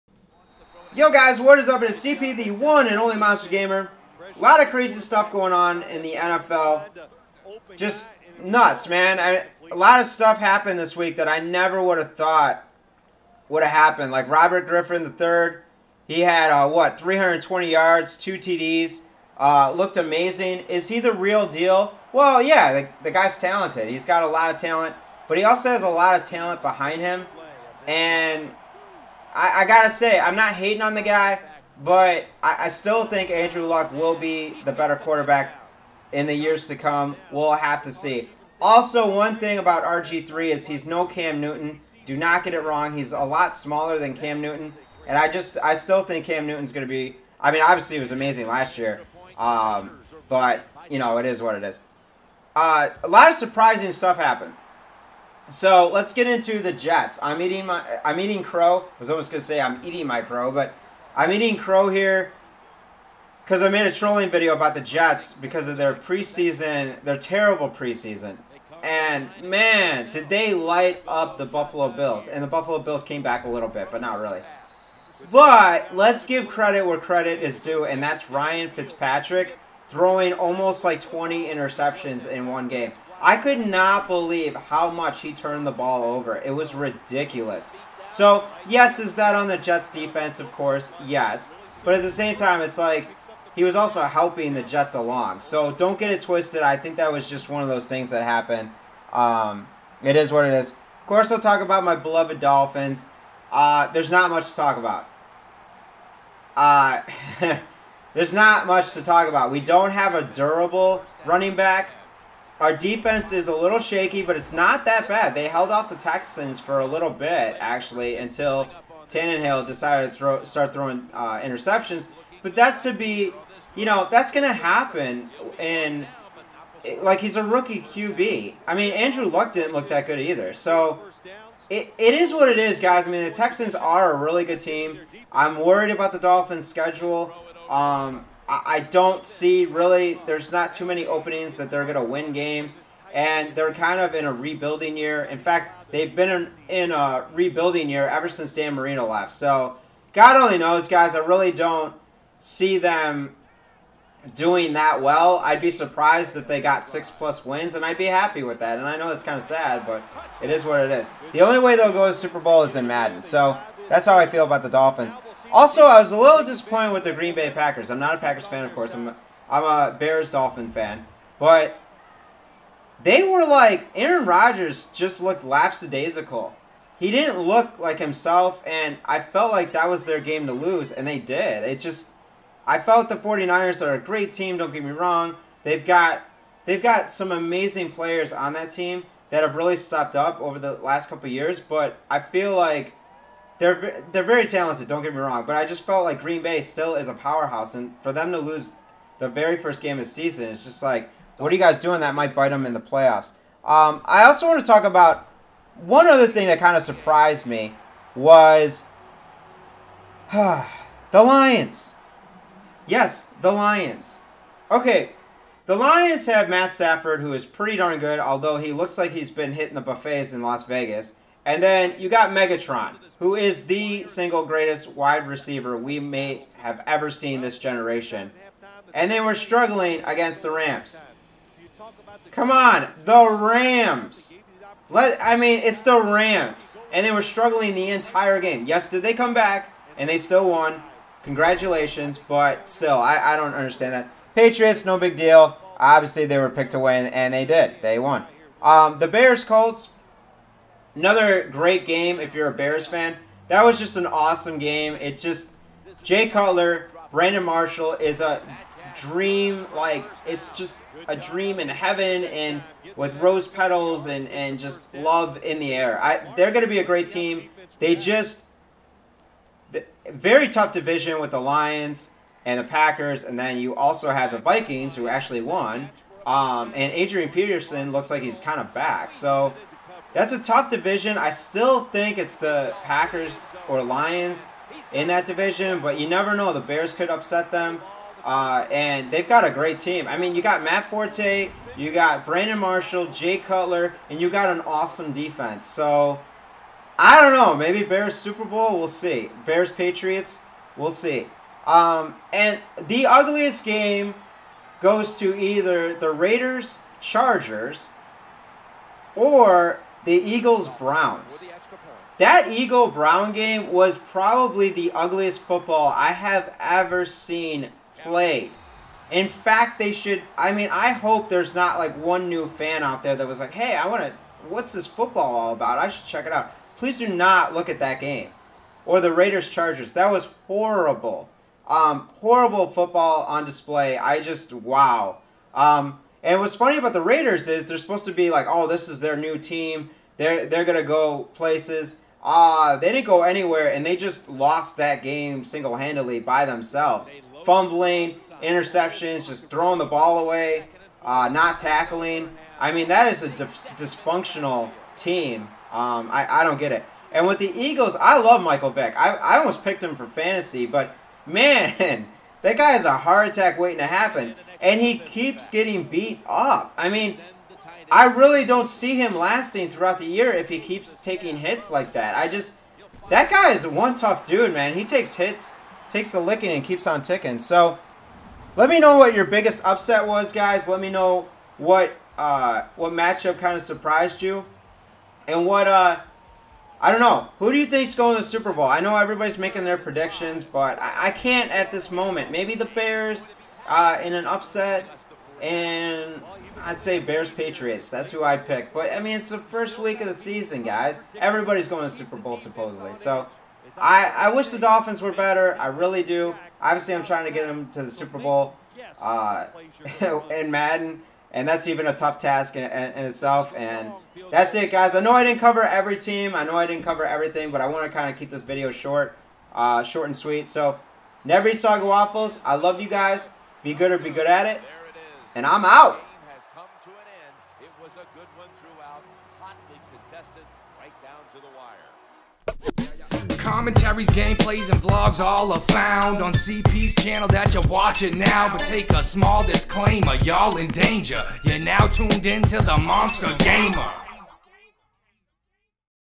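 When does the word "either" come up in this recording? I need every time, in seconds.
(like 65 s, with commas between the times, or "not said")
130 s, 305 s.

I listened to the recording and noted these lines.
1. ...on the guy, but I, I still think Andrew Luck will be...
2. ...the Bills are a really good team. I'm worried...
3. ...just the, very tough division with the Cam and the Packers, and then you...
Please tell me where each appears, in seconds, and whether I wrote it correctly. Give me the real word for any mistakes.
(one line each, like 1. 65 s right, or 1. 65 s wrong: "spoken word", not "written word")
1. 30 s right
2. 133 s wrong: "Texans", not "Bills"
3. 267 s wrong: "Lions", not "Cam".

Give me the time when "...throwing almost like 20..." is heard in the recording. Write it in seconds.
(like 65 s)
79 s.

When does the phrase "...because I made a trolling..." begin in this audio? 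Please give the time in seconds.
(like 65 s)
63 s.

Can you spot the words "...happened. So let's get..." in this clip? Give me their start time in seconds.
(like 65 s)
54 s.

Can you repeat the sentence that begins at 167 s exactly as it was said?
I'm not a Packers fan, of course.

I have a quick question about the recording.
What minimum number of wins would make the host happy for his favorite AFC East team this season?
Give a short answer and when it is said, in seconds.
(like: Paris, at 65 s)
6, at 156 s.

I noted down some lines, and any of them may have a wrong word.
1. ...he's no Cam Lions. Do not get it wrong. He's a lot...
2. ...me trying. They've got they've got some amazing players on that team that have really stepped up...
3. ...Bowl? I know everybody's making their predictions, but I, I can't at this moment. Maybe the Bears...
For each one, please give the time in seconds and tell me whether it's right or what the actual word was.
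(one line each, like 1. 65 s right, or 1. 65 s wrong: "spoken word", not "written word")
1. 40 s wrong: "Newton", not "Lions"
2. 184 s wrong: "wrong", not "trying"
3. 388 s right.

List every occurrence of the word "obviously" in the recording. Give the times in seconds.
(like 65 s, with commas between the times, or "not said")
47 s, 245 s, 406 s.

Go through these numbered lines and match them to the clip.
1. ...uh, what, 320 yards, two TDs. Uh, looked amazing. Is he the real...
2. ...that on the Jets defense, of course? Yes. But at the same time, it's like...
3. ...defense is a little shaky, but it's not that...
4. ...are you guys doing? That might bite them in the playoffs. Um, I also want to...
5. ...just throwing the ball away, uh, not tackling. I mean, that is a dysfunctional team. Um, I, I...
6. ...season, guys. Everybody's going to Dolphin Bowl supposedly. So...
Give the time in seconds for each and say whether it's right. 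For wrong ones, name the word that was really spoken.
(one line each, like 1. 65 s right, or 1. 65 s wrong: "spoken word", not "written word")
1. 16 s right
2. 89 s right
3. 112 s right
4. 201 s right
5. 349 s right
6. 400 s wrong: "Super", not "Dolphin".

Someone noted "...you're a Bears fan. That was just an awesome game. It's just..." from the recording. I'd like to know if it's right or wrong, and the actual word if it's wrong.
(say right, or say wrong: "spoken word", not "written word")
right.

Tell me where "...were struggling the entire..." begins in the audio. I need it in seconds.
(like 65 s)
237 s.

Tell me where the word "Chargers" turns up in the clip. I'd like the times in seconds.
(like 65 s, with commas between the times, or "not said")
306 s, 329 s.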